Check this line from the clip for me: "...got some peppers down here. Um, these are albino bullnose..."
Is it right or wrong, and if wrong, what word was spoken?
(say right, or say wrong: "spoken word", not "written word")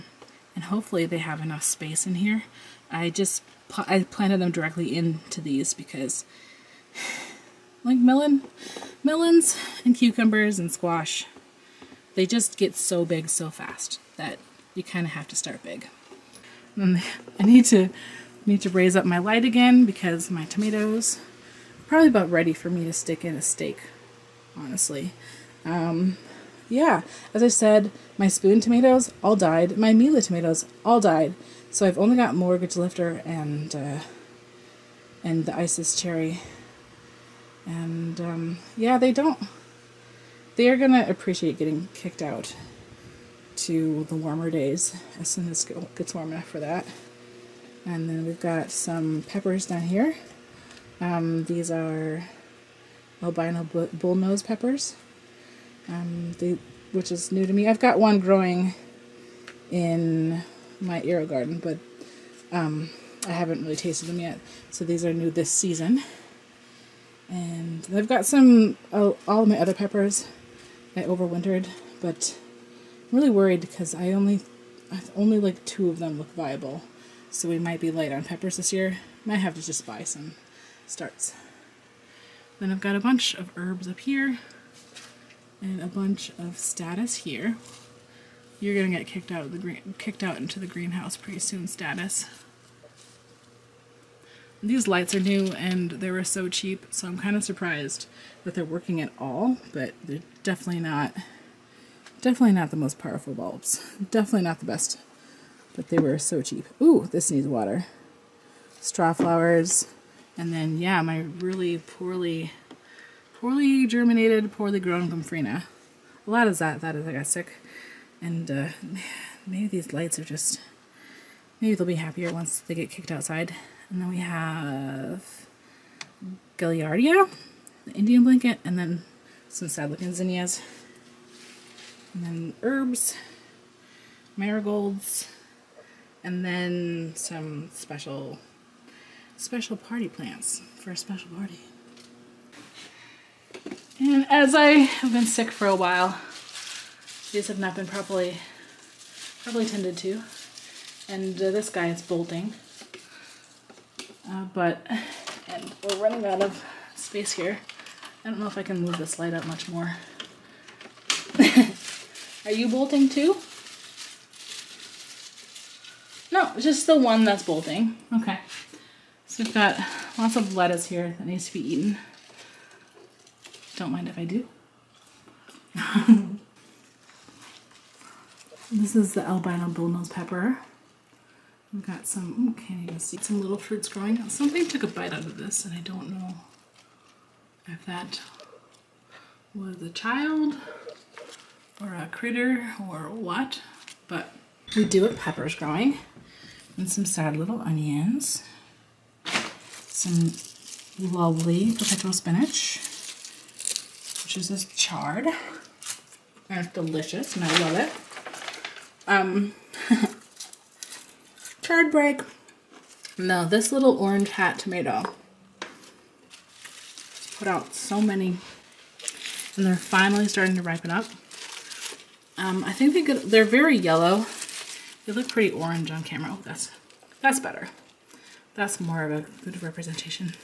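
right.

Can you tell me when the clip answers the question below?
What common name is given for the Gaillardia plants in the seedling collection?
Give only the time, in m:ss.
2:07.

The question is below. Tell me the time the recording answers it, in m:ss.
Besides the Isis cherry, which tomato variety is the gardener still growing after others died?
0:32.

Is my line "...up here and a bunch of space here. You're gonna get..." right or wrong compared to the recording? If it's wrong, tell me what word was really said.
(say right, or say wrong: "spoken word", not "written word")
wrong: "statice", not "space".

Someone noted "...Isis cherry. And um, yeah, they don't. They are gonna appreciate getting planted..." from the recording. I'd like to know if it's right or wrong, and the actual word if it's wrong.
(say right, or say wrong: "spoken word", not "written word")
wrong: "kicked", not "planted".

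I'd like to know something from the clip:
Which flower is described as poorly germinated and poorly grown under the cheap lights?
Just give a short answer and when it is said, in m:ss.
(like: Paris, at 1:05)
Gomphrena, at 1:55.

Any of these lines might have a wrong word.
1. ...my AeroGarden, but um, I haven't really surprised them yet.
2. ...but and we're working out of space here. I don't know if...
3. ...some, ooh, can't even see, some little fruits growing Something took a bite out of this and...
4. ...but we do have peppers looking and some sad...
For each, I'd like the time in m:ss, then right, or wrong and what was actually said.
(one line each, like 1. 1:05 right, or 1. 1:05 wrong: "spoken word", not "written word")
1. 1:00 wrong: "tasted", not "surprised"
2. 2:34 wrong: "running", not "working"
3. 3:02 right
4. 3:14 wrong: "growing", not "looking".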